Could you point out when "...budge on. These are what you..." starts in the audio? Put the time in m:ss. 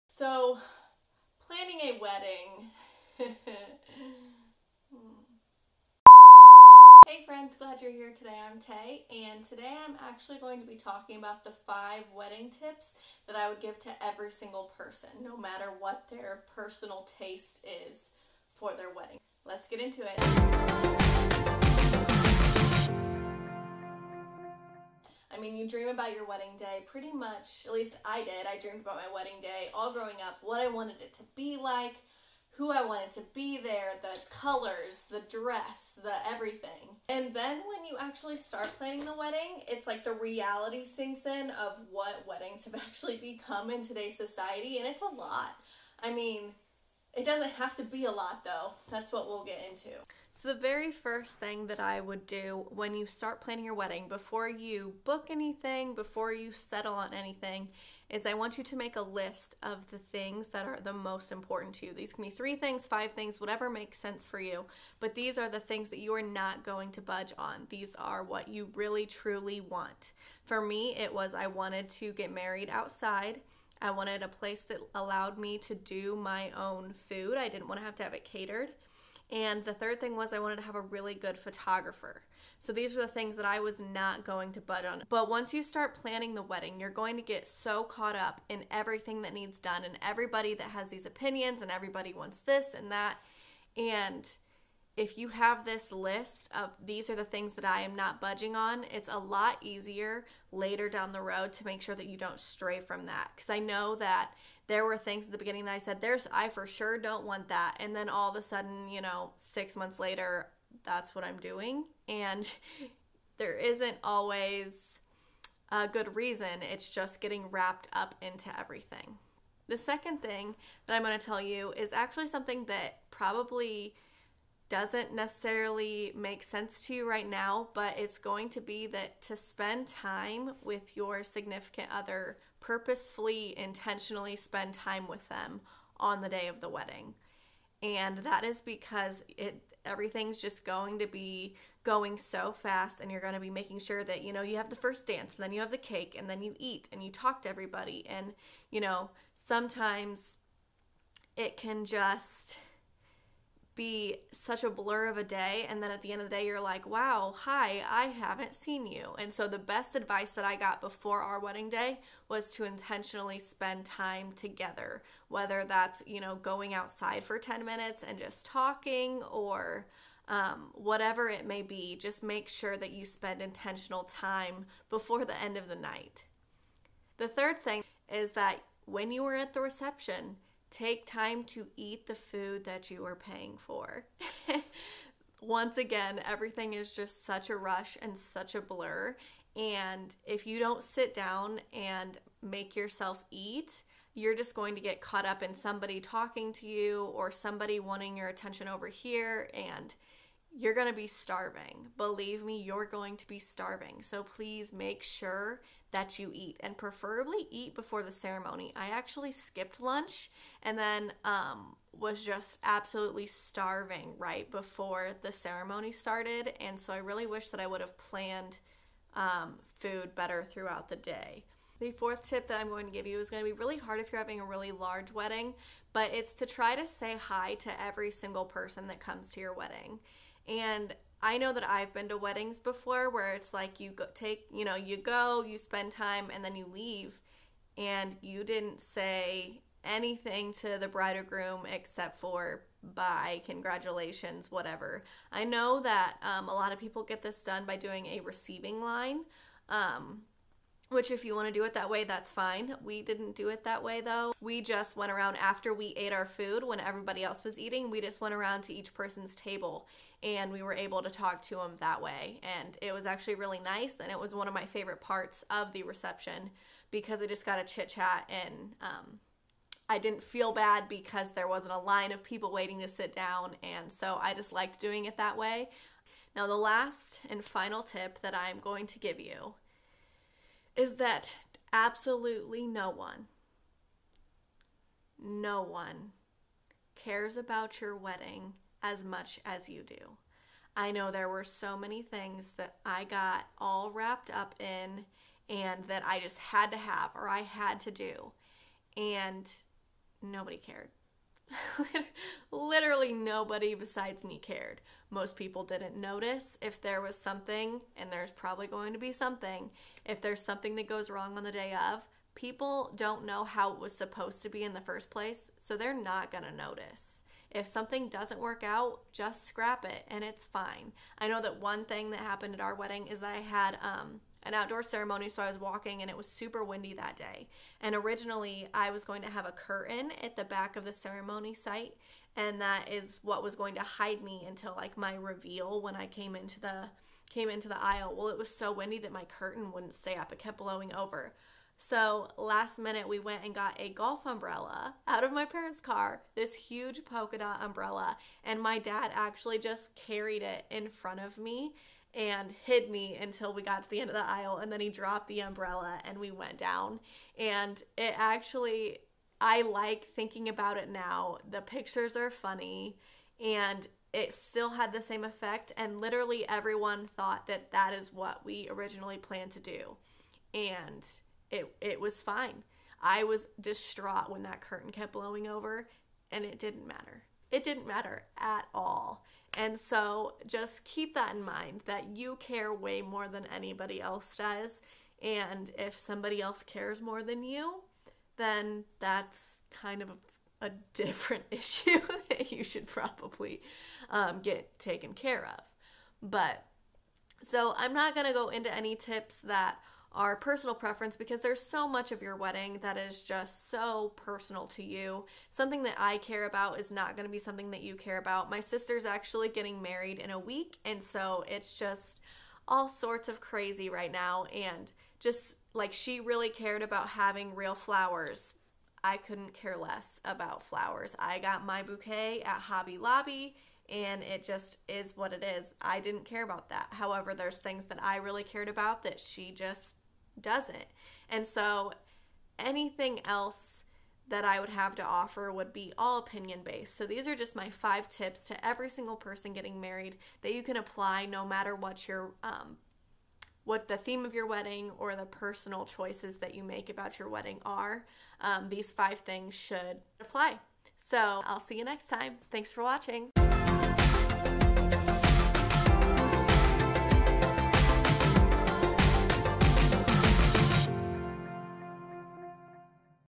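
1:07.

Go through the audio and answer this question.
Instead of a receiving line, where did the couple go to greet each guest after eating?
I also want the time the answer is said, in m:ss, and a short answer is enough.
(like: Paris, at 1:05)
Each person's table, at 4:18.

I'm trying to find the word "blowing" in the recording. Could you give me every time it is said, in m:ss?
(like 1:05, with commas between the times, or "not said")
5:40, 6:15.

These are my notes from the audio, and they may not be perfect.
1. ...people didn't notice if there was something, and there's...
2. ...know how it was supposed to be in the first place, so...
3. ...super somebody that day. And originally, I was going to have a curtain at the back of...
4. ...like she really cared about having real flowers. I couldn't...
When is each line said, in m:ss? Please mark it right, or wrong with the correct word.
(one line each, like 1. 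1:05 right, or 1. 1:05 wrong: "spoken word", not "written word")
1. 5:05 right
2. 5:13 right
3. 5:26 wrong: "windy", not "somebody"
4. 6:55 right.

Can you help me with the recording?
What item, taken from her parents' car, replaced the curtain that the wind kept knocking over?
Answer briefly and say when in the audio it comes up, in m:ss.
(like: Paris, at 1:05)
Golf umbrella, at 5:43.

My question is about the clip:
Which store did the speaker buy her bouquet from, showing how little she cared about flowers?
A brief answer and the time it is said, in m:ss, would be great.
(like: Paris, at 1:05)
Hobby Lobby, at 7:02.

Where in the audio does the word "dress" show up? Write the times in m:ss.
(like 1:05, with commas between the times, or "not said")
0:35.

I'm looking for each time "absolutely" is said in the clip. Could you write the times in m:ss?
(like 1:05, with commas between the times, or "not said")
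3:32, 4:41.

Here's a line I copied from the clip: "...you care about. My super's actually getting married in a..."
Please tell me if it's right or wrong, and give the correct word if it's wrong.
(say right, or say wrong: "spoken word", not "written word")
wrong: "sister", not "super".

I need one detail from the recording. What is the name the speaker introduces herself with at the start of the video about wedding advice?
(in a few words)
Tay.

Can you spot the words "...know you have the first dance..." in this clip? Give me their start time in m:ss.
2:24.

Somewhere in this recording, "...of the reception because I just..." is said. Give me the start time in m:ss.
4:25.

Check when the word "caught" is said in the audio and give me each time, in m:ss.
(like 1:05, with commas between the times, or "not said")
1:27, 3:15.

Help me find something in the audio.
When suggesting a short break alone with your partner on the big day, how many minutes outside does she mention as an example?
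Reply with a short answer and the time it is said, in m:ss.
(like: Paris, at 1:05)
10, at 2:47.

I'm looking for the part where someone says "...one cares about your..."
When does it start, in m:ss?
4:45.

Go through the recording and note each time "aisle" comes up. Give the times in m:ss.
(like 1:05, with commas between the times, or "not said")
5:37, 5:54.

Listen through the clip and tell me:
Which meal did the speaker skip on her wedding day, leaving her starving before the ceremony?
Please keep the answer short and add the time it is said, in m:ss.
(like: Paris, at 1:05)
Lunch, at 3:29.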